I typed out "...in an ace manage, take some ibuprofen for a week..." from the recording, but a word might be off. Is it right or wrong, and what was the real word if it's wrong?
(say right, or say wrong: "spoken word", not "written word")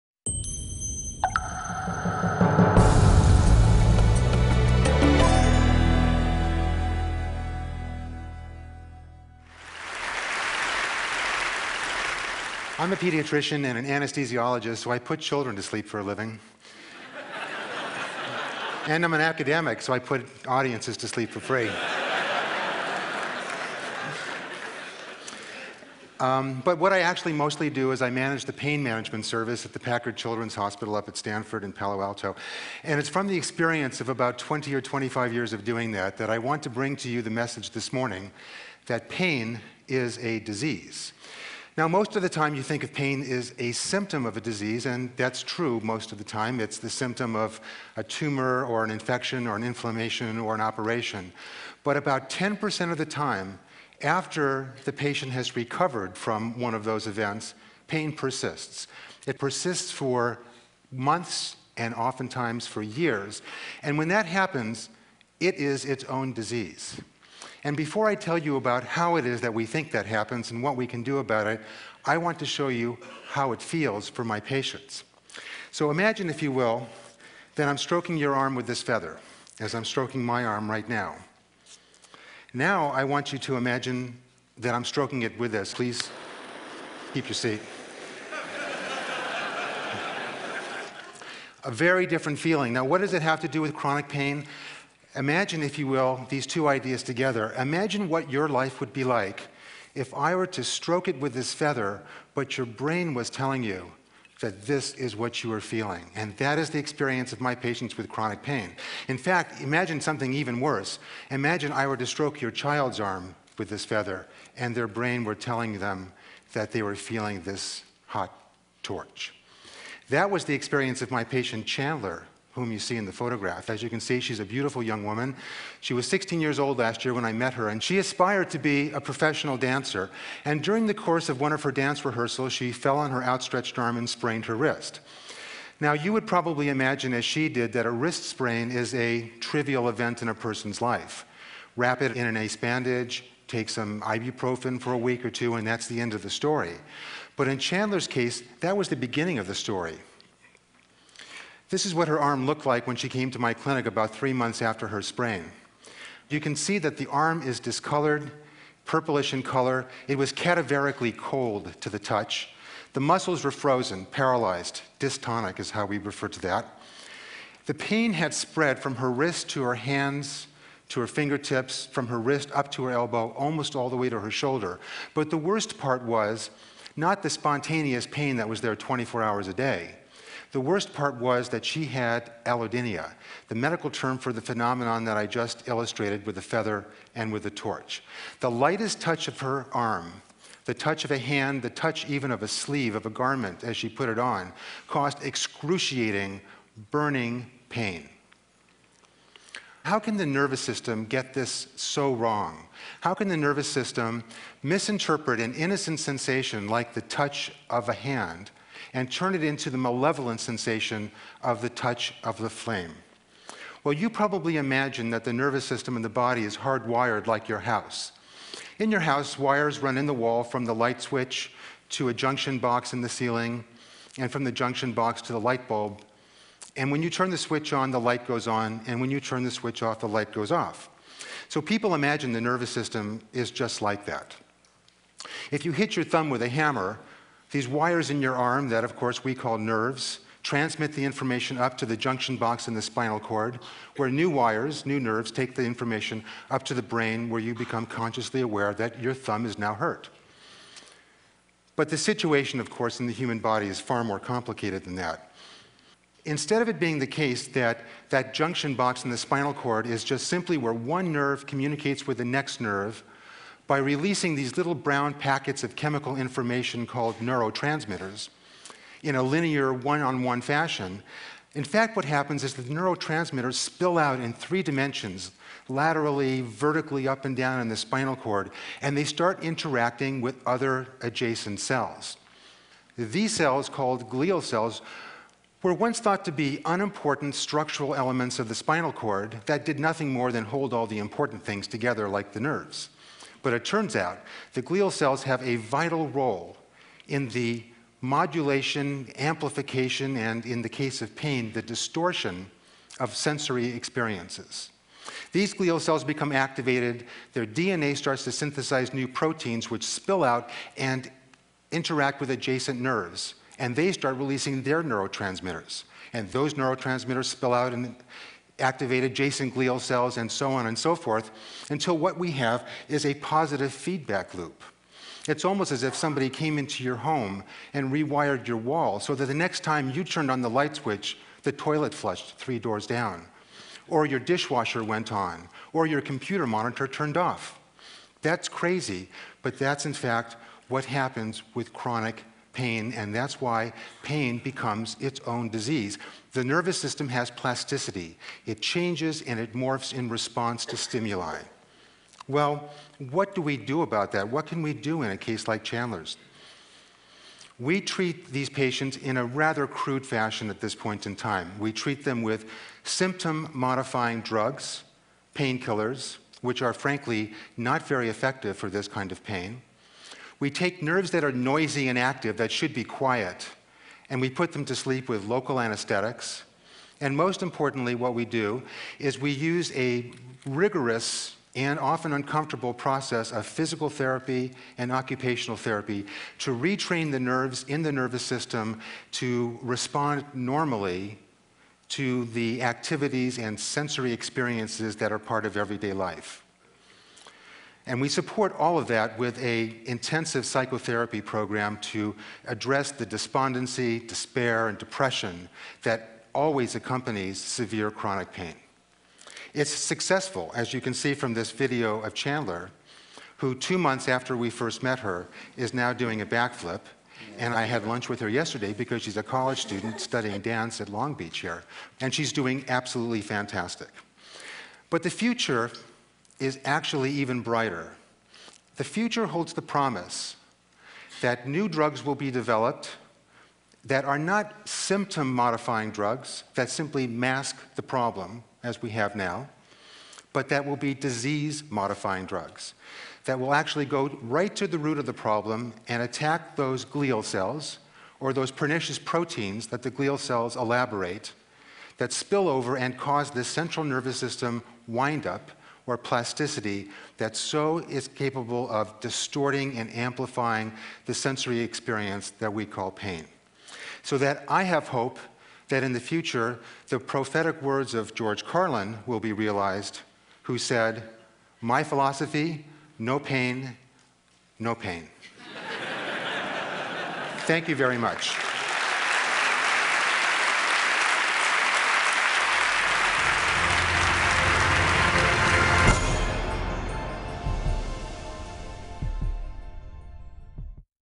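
wrong: "bandage", not "manage".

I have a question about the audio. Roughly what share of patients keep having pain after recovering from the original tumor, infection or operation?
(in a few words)
10%.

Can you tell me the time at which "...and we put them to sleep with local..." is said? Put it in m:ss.
6:14.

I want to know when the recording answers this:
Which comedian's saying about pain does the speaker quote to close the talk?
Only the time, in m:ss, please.
7:48.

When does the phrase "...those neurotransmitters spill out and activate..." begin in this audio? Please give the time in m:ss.
5:16.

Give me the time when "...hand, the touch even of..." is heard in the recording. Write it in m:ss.
3:11.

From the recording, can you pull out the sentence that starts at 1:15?
So imagine, if you will, that I'm stroking your arm with this feather, as I'm stroking my arm right now.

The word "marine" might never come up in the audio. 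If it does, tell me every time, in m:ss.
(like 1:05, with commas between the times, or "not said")
not said.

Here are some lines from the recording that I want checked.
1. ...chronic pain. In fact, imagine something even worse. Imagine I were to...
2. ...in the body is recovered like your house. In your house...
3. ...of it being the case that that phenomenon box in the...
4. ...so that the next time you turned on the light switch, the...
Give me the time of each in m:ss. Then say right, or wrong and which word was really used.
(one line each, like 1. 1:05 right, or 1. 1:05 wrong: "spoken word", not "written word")
1. 1:48 right
2. 3:35 wrong: "hardwired", not "recovered"
3. 4:16 wrong: "junction", not "phenomenon"
4. 5:28 right.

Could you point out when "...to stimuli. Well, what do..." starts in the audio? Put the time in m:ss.
5:50.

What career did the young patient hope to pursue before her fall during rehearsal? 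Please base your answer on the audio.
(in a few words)
Professional dancer.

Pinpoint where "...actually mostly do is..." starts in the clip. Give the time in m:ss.
0:27.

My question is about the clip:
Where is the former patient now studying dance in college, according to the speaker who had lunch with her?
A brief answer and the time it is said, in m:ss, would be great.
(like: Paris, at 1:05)
Long Beach, at 7:00.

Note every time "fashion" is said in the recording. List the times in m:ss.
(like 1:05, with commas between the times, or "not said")
4:30, 6:00.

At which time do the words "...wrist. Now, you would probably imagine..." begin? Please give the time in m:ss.
2:14.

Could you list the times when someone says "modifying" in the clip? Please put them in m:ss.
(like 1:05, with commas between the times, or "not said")
6:03, 7:15, 7:21.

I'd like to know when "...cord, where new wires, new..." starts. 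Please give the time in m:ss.
4:03.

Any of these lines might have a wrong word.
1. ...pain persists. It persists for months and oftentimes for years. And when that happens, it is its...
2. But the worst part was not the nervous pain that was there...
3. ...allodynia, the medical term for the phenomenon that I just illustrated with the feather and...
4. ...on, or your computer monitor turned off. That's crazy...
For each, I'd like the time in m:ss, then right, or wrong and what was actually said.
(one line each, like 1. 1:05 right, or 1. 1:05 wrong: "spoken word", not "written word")
1. 0:57 right
2. 2:55 wrong: "spontaneous", not "nervous"
3. 3:02 right
4. 5:35 right.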